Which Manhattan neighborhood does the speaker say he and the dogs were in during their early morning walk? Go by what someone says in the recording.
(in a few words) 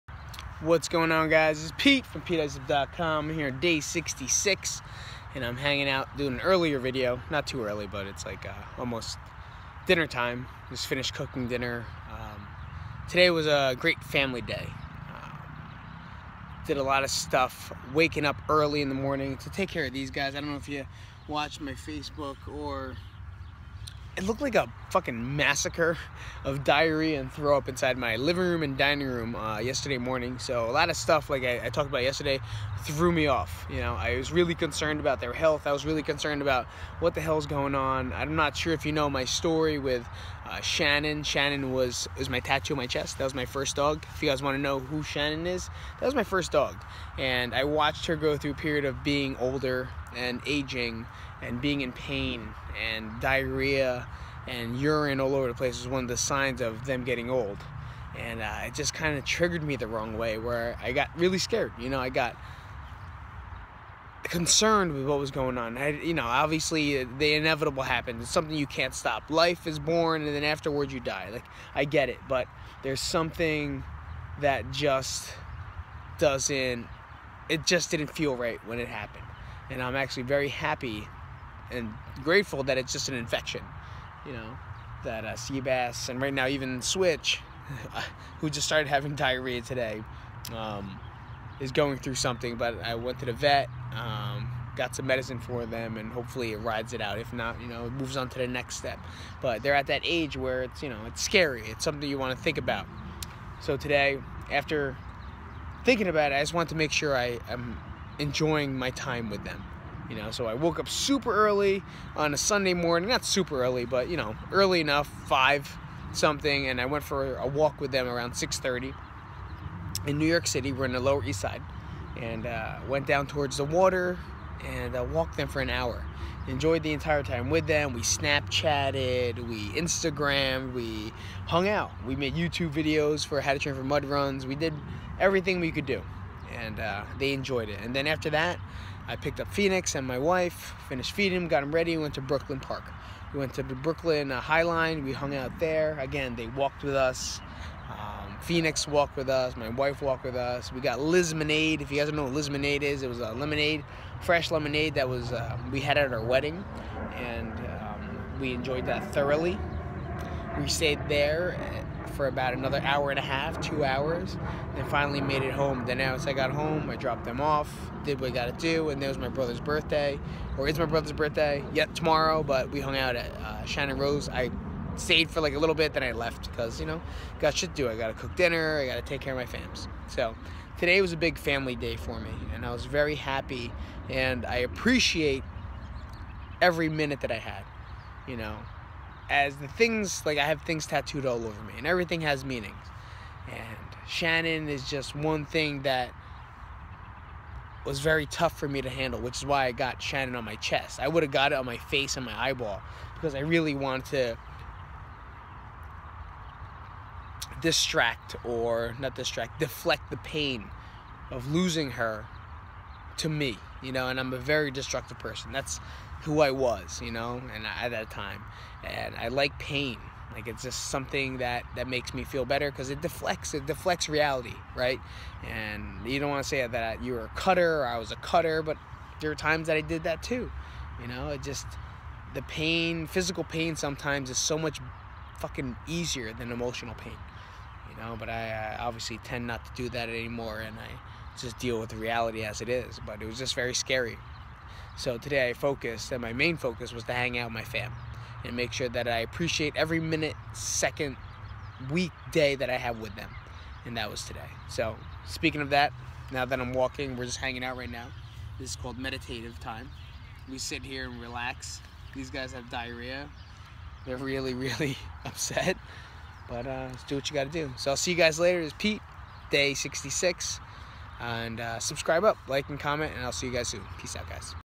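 Lower East Side.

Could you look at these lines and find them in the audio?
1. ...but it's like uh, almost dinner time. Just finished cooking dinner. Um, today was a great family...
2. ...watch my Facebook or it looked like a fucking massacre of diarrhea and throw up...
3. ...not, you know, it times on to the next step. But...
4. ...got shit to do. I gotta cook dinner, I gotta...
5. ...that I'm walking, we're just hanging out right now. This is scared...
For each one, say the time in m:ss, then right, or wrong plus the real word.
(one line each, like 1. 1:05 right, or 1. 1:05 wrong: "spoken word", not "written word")
1. 0:07 right
2. 0:21 right
3. 1:37 wrong: "moves", not "times"
4. 2:57 right
5. 4:16 wrong: "called", not "scared".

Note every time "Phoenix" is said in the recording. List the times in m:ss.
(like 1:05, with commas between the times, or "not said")
2:19, 2:28.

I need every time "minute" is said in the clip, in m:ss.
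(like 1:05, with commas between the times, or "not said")
3:06, 4:09.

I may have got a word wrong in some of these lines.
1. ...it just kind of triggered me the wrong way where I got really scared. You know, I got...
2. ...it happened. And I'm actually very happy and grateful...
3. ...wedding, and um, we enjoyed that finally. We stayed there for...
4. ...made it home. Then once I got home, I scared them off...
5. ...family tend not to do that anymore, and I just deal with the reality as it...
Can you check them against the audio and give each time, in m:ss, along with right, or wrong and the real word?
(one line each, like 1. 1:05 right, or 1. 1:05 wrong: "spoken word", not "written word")
1. 0:58 right
2. 1:18 right
3. 2:36 wrong: "thoroughly", not "finally"
4. 2:45 wrong: "dropped", not "scared"
5. 3:58 wrong: "obviously", not "family".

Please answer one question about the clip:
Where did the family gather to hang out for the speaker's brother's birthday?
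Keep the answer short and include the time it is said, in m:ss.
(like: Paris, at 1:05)
Shannon Rose, at 2:53.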